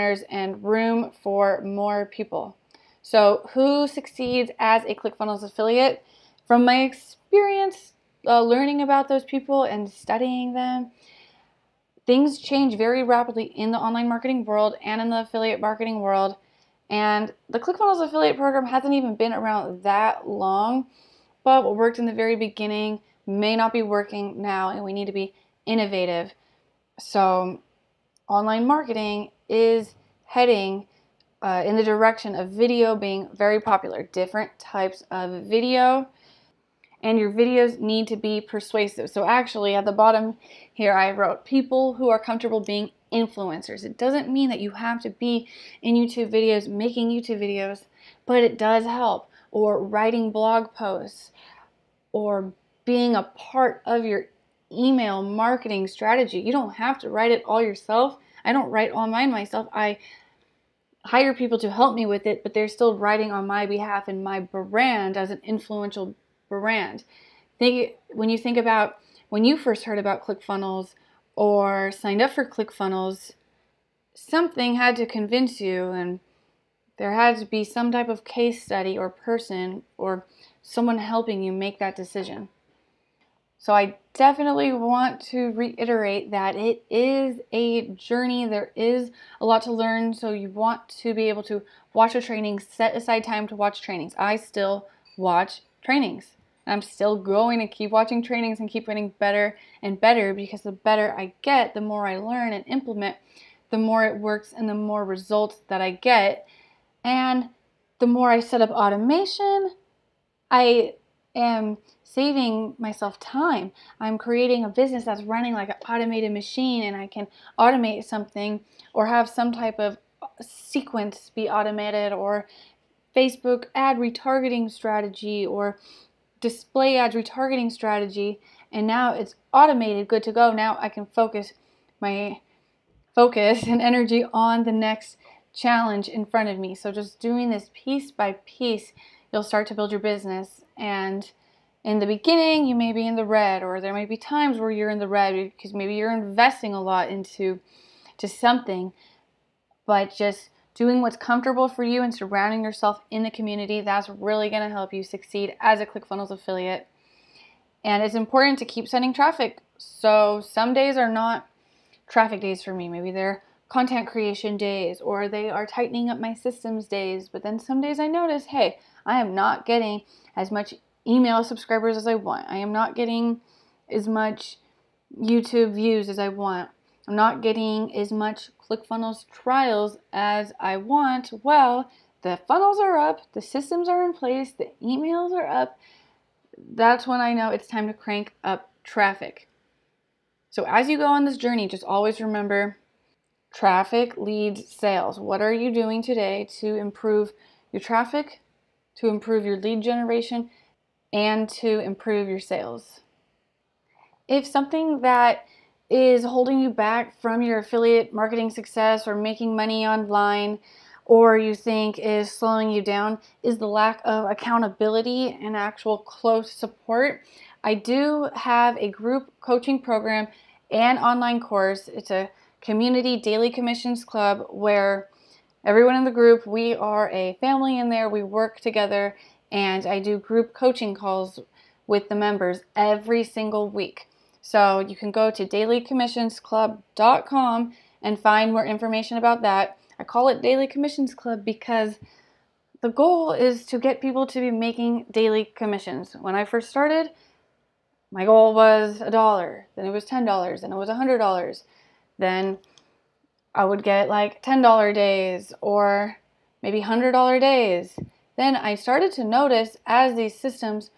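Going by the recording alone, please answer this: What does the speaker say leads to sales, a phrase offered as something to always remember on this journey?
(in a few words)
traffic leads sales.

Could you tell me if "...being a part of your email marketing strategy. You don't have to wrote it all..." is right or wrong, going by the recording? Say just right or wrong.
wrong.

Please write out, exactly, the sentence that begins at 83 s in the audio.
So I definitely want to reiterate that it is a journey.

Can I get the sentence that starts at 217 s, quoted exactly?
I do have a group coaching program and online course.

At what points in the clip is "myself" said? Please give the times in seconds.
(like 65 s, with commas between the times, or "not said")
59 s, 112 s.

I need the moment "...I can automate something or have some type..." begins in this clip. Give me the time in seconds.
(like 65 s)
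116 s.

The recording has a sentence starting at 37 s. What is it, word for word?
And your videos need to be persuasive.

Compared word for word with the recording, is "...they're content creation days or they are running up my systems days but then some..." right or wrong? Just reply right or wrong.
wrong.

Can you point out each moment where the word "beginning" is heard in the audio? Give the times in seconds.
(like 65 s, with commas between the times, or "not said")
22 s, 142 s.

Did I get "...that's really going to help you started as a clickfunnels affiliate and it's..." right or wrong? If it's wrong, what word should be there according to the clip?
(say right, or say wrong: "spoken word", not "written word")
wrong: "succeed", not "started".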